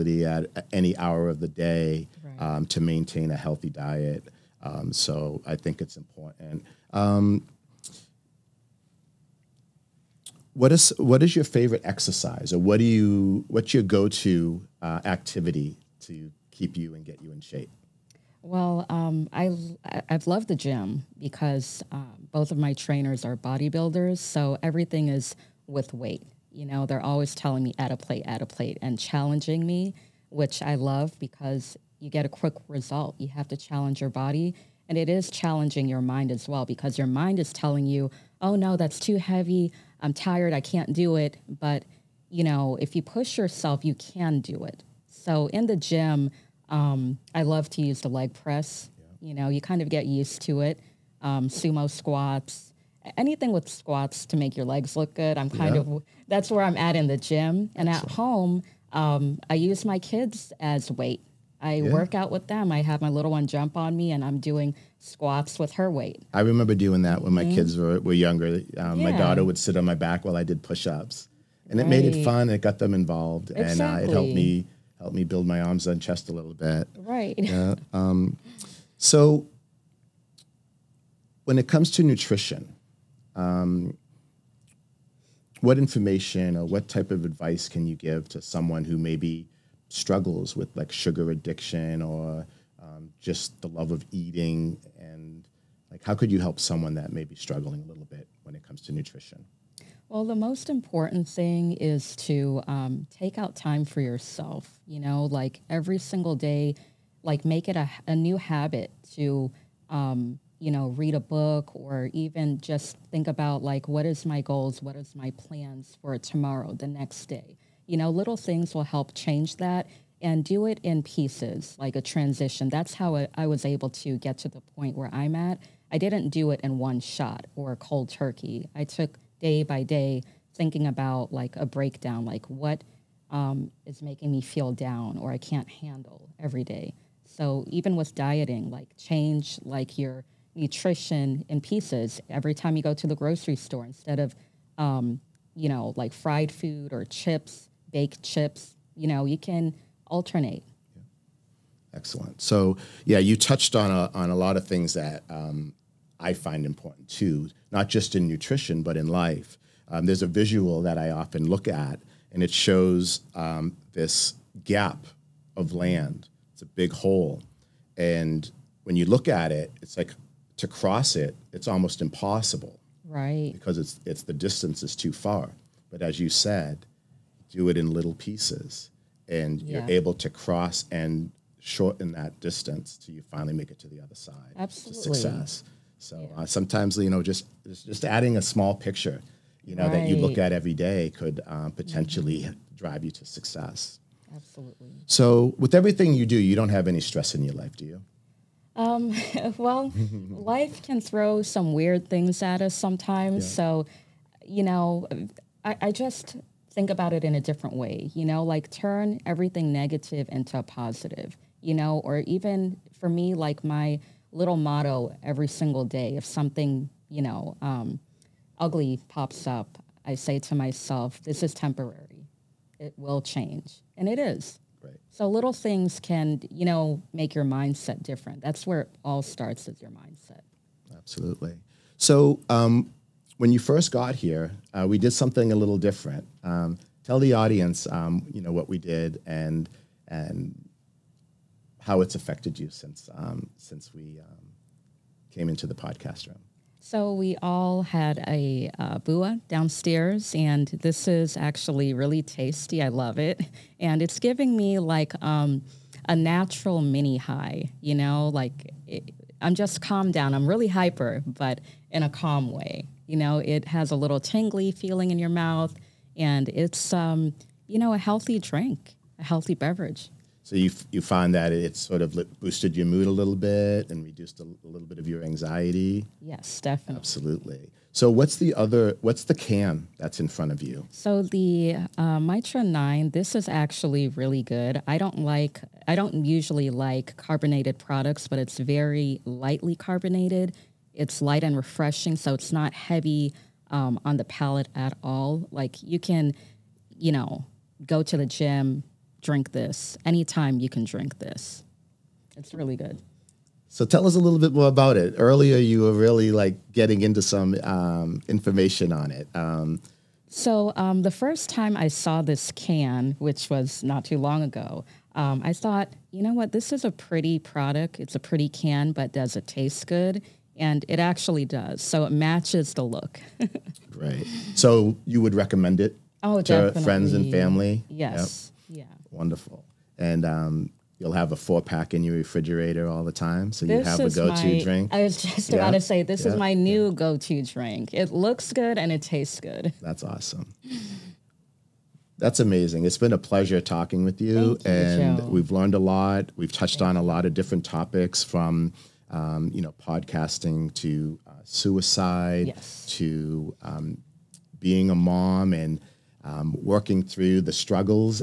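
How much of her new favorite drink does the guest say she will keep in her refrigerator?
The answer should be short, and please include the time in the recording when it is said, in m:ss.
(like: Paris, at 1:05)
four pack, at 5:31.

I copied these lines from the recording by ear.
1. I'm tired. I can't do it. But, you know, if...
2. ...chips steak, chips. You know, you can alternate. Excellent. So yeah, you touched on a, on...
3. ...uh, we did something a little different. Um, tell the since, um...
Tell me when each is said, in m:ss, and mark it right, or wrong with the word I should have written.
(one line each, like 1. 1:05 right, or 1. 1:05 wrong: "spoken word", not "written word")
1. 0:40 right
2. 2:27 right
3. 3:54 wrong: "audience", not "since".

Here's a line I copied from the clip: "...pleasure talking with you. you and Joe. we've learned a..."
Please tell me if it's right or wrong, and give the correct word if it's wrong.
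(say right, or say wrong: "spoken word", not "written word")
right.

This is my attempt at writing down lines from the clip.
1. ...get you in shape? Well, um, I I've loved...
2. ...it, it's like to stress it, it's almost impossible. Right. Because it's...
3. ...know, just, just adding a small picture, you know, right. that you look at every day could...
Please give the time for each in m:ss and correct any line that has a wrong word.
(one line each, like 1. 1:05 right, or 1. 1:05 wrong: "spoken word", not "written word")
1. 0:17 right
2. 2:49 wrong: "cross", not "stress"
3. 3:07 right.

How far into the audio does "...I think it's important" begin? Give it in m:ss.
0:05.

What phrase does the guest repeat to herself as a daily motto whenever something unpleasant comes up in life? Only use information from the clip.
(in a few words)
This is temporary.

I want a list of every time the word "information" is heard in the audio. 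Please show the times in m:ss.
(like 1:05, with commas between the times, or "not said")
1:25, 5:08.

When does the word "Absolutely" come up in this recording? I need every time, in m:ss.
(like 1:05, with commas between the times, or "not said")
3:04, 3:14, 3:50, 4:36.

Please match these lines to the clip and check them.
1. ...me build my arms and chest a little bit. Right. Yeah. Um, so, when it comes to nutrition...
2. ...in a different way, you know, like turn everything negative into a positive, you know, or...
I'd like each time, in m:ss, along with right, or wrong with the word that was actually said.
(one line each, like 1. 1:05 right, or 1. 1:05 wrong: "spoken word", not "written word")
1. 1:15 right
2. 3:27 right.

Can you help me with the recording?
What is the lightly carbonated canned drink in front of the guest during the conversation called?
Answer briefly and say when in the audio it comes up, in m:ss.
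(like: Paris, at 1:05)
Mitra Nine, at 4:42.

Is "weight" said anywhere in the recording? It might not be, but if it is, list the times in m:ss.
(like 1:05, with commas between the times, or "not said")
0:25, 1:00, 1:05.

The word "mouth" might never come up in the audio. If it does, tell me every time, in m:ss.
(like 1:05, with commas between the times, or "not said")
4:25.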